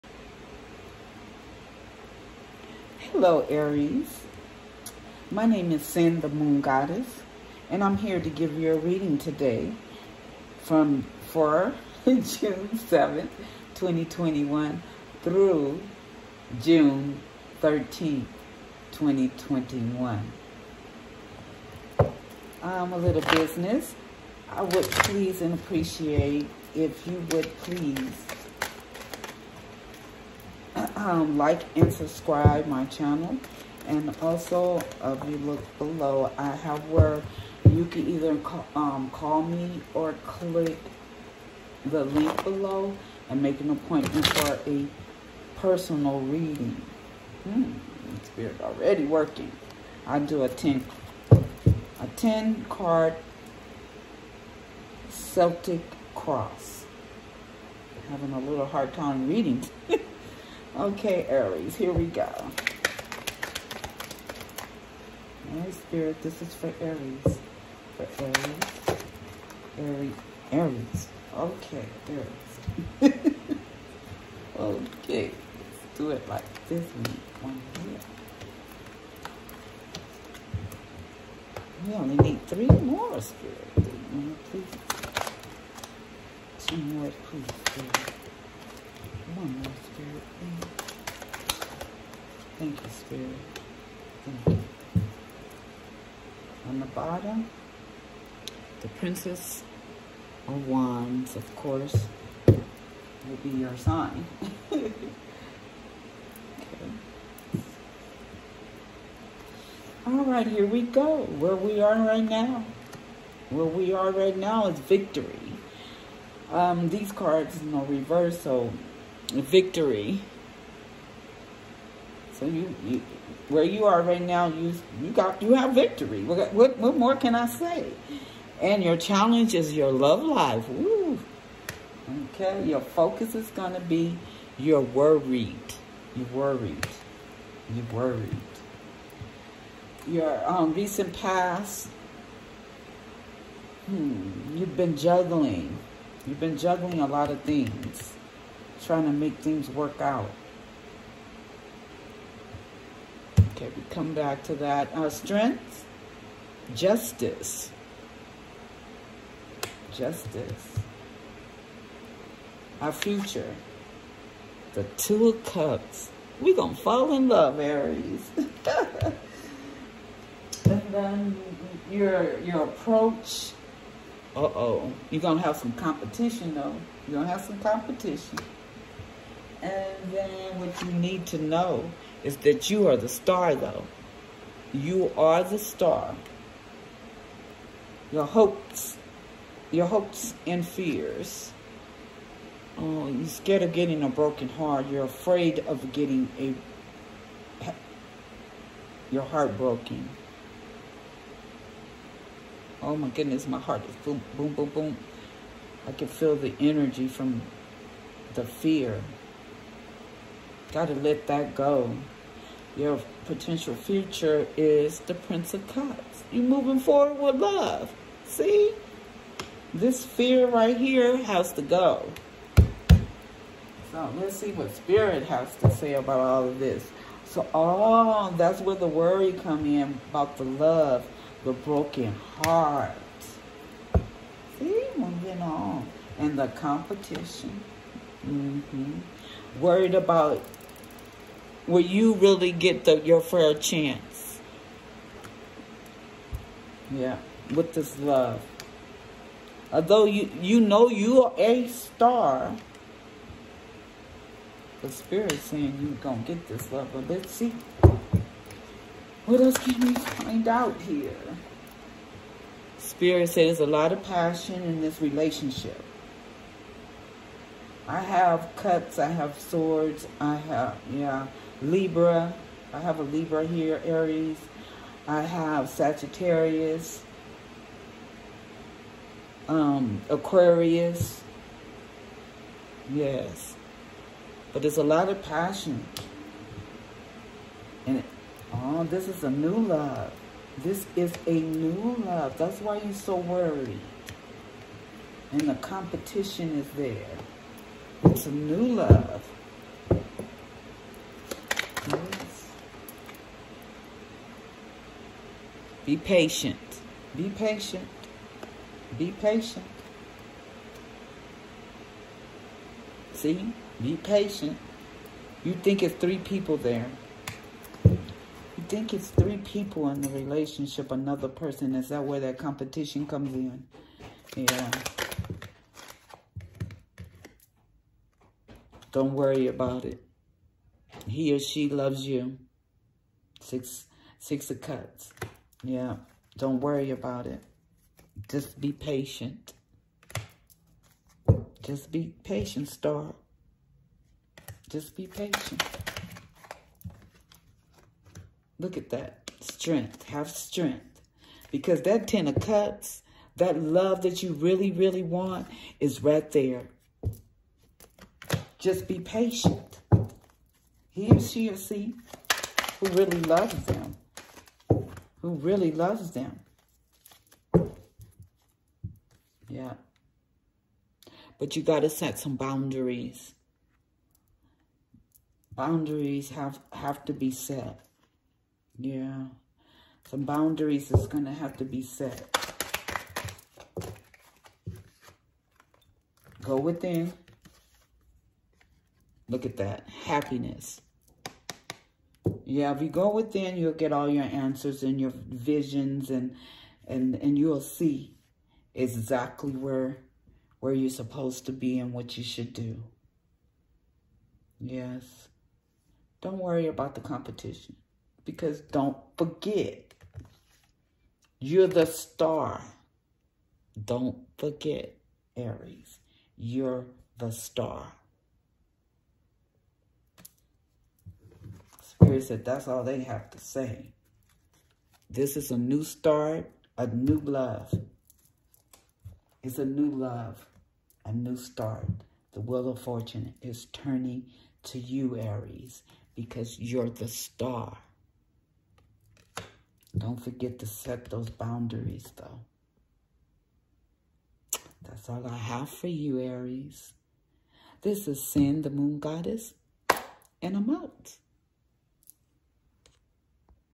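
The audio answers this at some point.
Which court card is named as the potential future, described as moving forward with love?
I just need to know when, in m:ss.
3:35.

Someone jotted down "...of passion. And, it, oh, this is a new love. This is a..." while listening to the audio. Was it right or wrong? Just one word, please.
right.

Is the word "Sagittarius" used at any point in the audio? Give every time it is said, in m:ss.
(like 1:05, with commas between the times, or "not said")
4:35.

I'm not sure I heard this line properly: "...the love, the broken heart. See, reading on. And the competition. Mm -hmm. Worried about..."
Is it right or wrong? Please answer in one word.
wrong.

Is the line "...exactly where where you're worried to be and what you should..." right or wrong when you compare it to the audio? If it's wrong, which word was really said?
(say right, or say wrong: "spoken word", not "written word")
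wrong: "supposed", not "worried".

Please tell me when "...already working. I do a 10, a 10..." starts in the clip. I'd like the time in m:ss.
0:48.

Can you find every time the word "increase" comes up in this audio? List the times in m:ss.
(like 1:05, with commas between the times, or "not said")
not said.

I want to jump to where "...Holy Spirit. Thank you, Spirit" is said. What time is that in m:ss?
1:29.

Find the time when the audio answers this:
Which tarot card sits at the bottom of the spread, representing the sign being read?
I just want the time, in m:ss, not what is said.
1:38.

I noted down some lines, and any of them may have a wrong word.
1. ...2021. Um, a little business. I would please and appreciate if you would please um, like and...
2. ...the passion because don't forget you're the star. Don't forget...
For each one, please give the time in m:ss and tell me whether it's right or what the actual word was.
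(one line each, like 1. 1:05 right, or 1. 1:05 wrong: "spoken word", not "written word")
1. 0:18 right
2. 6:46 wrong: "competition", not "passion".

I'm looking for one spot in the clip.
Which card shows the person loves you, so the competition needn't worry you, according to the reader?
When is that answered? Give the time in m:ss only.
5:34.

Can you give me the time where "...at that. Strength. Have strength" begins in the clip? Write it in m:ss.
5:48.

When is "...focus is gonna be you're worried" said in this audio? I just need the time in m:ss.
2:12.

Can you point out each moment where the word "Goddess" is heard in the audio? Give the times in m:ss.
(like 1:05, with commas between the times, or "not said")
0:06, 7:28.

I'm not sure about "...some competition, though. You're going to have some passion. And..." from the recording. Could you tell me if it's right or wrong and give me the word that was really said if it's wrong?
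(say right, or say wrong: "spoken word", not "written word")
wrong: "competition", not "passion".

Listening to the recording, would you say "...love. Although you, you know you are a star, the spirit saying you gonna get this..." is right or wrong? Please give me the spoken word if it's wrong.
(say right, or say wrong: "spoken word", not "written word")
right.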